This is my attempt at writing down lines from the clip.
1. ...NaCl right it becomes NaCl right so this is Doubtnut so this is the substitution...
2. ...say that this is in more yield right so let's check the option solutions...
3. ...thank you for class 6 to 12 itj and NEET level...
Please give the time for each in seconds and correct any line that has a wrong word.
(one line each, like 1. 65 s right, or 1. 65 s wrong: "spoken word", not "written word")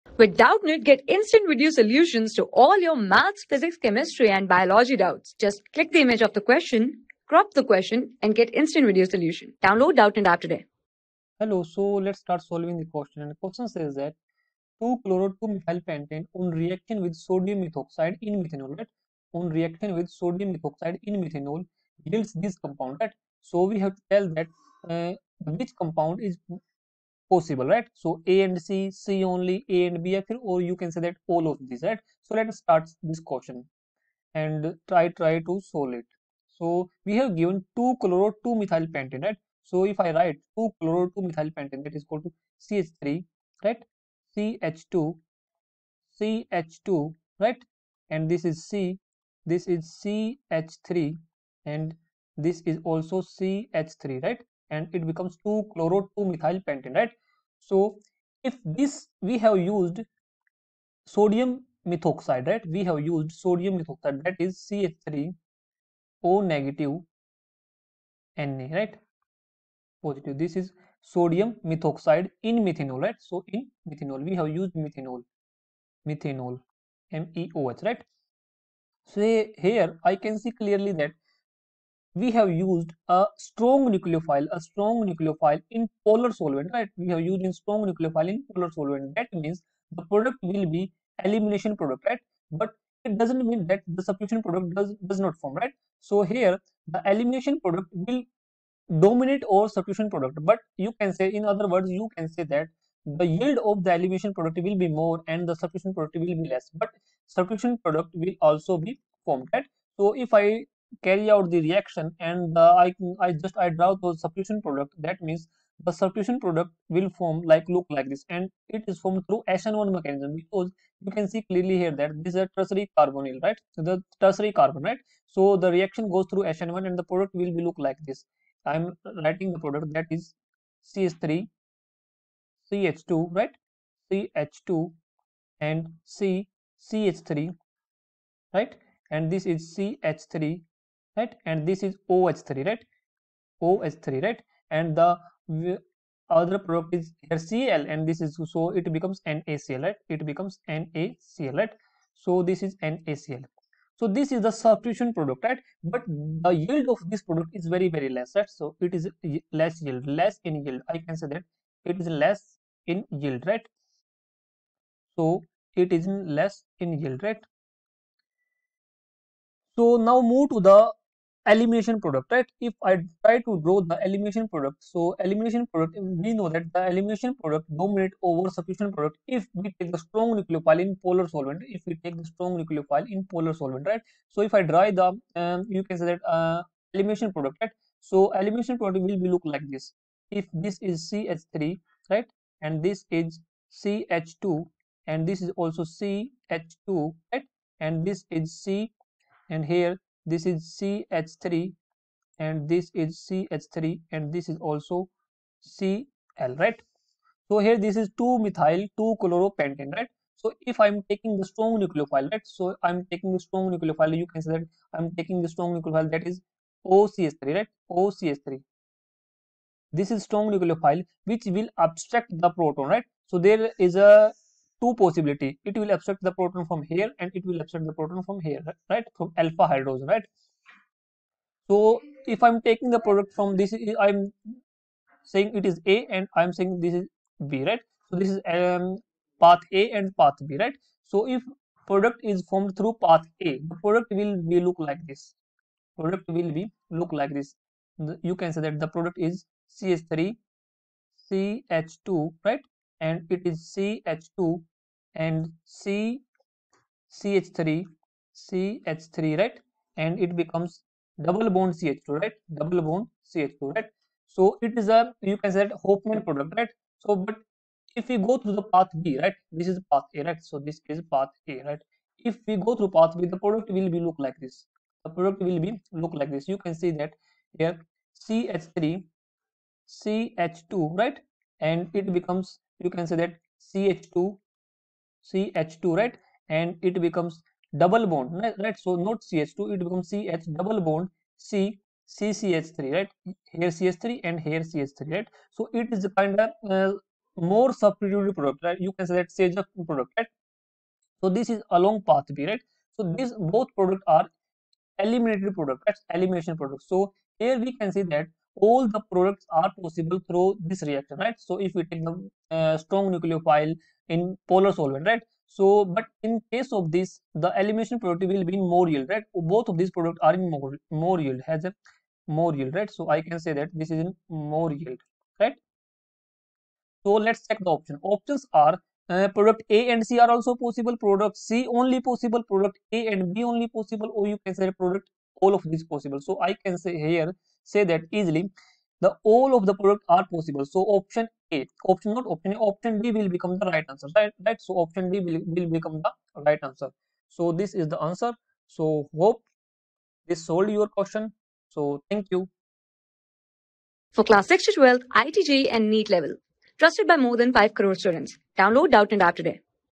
1. 149 s wrong: "NaCl", not "Doubtnut"
2. 323 s wrong: "options", not "solutions"
3. 352 s right.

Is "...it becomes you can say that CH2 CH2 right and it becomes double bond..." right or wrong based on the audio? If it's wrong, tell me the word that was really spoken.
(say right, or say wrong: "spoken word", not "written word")
right.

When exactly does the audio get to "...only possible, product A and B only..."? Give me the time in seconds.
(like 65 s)
331 s.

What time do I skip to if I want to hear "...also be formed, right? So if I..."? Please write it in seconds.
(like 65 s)
108 s.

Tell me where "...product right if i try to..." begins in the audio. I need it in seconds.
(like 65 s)
171 s.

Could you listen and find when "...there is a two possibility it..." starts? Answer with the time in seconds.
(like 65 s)
223 s.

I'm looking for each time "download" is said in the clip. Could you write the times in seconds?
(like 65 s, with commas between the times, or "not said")
9 s, 358 s.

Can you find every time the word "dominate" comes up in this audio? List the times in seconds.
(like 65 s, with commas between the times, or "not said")
98 s, 177 s.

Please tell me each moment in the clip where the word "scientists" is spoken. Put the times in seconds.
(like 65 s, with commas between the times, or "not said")
not said.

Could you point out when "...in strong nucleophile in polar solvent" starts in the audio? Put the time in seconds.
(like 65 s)
87 s.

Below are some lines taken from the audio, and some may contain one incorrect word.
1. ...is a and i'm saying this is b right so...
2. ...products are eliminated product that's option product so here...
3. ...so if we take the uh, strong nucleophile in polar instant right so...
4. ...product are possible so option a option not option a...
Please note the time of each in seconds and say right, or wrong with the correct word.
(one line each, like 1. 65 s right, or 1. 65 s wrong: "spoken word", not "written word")
1. 235 s right
2. 303 s wrong: "elimination", not "option"
3. 311 s wrong: "solvent", not "instant"
4. 339 s right.